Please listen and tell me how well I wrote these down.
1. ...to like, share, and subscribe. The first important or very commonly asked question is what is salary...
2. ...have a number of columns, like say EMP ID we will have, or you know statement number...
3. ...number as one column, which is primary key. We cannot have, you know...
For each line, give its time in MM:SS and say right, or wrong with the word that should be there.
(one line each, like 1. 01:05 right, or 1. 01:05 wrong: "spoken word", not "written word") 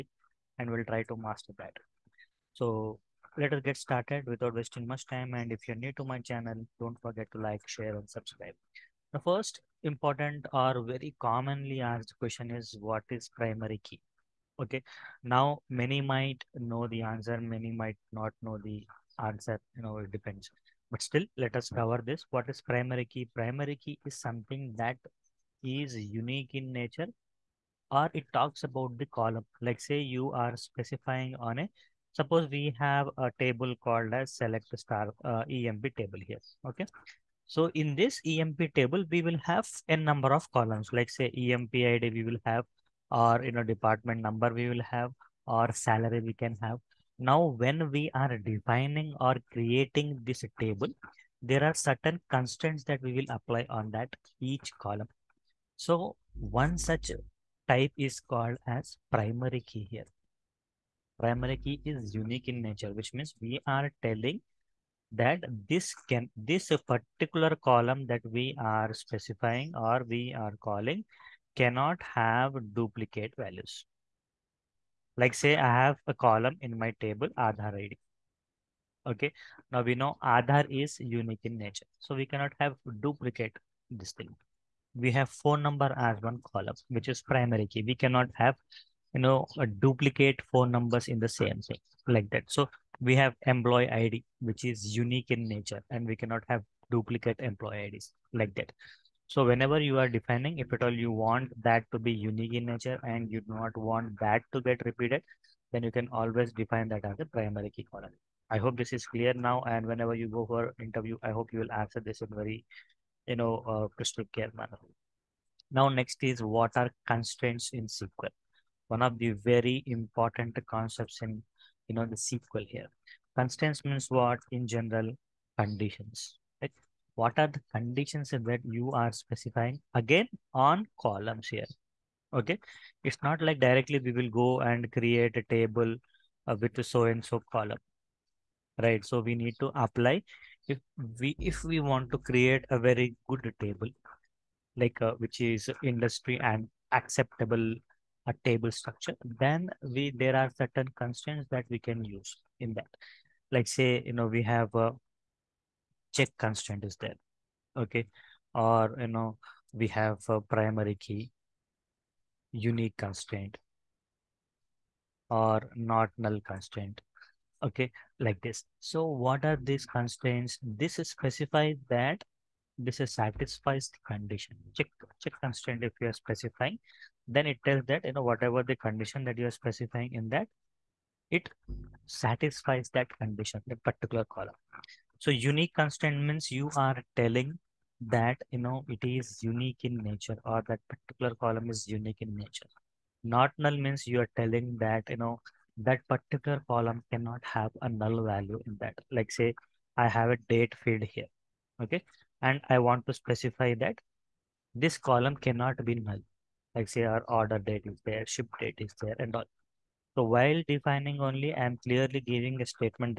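1. 00:07 wrong: "primary", not "salary"
2. 00:39 wrong: "department", not "statement"
3. 01:25 right.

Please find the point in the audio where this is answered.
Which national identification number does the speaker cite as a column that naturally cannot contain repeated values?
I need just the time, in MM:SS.
01:17.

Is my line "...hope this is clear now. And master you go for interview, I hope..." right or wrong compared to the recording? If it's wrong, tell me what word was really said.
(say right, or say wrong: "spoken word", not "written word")
wrong: "whenever", not "master".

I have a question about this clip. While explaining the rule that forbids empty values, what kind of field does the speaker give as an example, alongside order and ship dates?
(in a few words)
Date field.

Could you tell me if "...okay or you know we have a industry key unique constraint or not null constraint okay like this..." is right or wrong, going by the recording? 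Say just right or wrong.
wrong.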